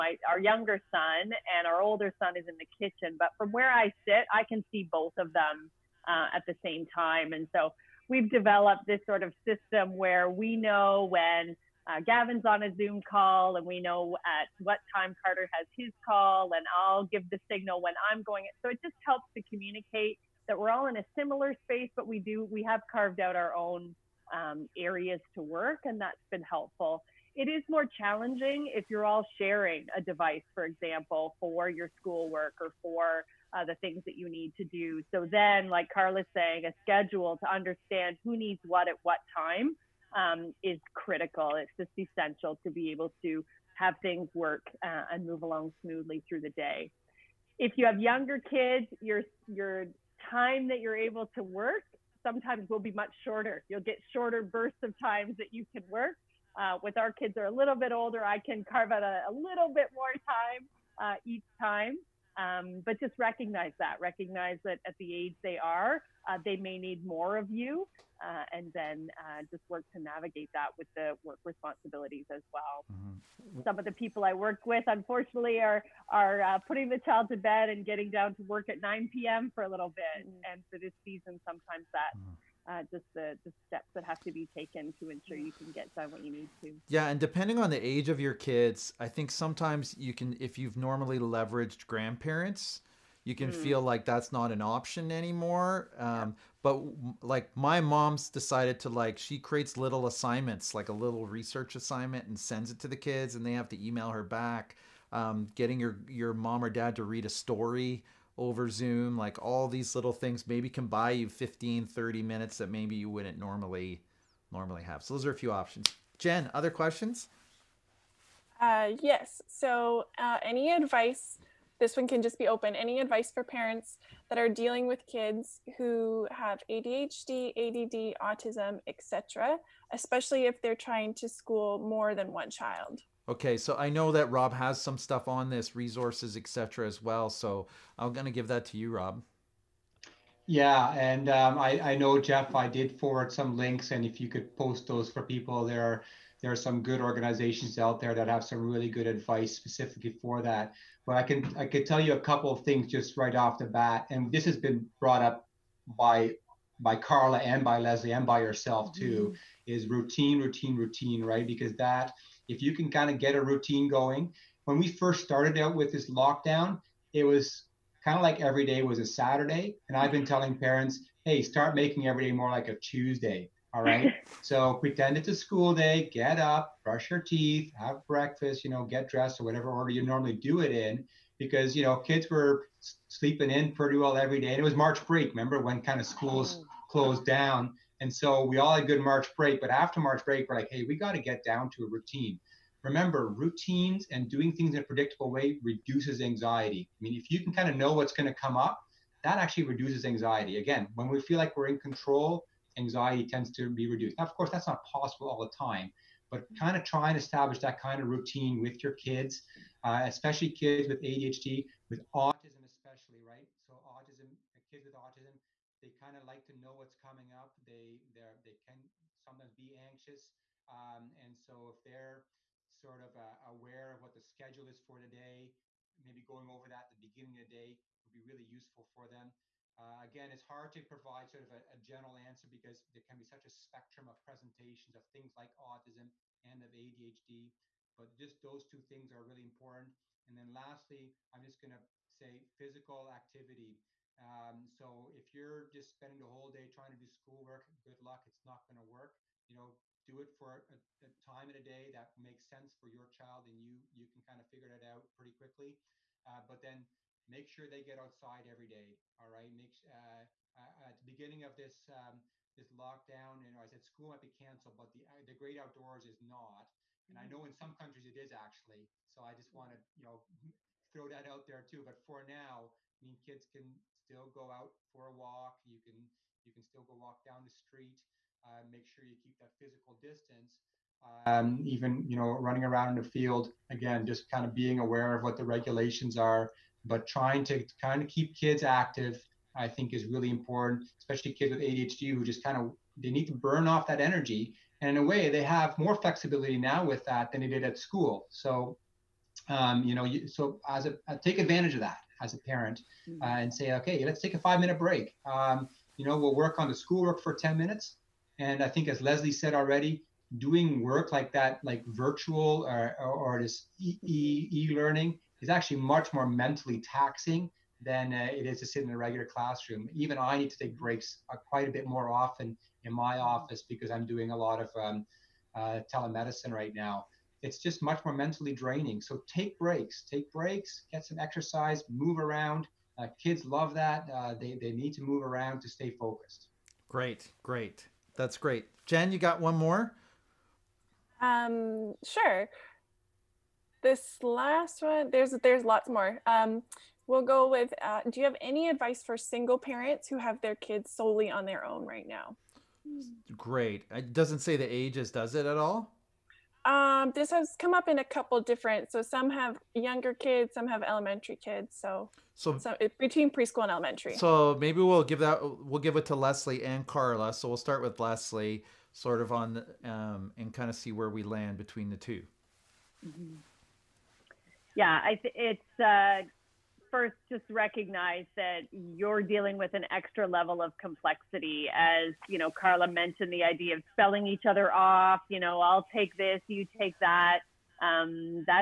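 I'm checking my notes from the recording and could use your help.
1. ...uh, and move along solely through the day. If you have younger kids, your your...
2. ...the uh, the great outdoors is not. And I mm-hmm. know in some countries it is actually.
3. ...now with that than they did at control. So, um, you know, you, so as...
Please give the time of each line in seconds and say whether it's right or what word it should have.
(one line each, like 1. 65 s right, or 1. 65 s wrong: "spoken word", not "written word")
1. 44 s wrong: "smoothly", not "solely"
2. 264 s right
3. 296 s wrong: "school", not "control".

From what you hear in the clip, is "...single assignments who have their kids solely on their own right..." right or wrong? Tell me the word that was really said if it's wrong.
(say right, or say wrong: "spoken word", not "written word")
wrong: "parents", not "assignments".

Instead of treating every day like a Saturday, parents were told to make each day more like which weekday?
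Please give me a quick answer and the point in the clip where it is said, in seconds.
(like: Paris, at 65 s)
Tuesday, at 172 s.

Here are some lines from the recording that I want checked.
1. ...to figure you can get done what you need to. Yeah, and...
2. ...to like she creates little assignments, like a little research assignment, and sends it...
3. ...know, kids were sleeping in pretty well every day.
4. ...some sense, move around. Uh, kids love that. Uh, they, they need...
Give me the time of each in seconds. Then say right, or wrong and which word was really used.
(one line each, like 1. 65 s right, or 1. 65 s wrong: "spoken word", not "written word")
1. 84 s wrong: "ensure", not "figure"
2. 98 s right
3. 181 s right
4. 331 s wrong: "exercise", not "sense".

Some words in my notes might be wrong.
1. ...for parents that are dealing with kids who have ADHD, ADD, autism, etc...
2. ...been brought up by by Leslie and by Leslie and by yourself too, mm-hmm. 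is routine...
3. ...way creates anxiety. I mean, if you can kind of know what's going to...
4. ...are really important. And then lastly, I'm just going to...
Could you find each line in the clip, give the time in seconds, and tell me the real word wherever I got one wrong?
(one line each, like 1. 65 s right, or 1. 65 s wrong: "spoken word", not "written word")
1. 123 s right
2. 154 s wrong: "Carla", not "Leslie"
3. 195 s wrong: "reduces", not "creates"
4. 239 s right.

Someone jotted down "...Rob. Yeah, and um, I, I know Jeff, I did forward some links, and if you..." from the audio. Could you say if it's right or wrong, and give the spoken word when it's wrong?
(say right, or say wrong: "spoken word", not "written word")
right.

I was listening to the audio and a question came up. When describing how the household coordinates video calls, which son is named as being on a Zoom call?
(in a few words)
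Gavin.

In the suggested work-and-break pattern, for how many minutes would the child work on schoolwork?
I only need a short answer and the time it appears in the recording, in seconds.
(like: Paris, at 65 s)
10, at 307 s.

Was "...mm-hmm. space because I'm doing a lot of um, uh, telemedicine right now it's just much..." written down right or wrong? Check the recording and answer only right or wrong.
wrong.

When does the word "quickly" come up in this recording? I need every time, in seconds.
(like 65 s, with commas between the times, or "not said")
255 s.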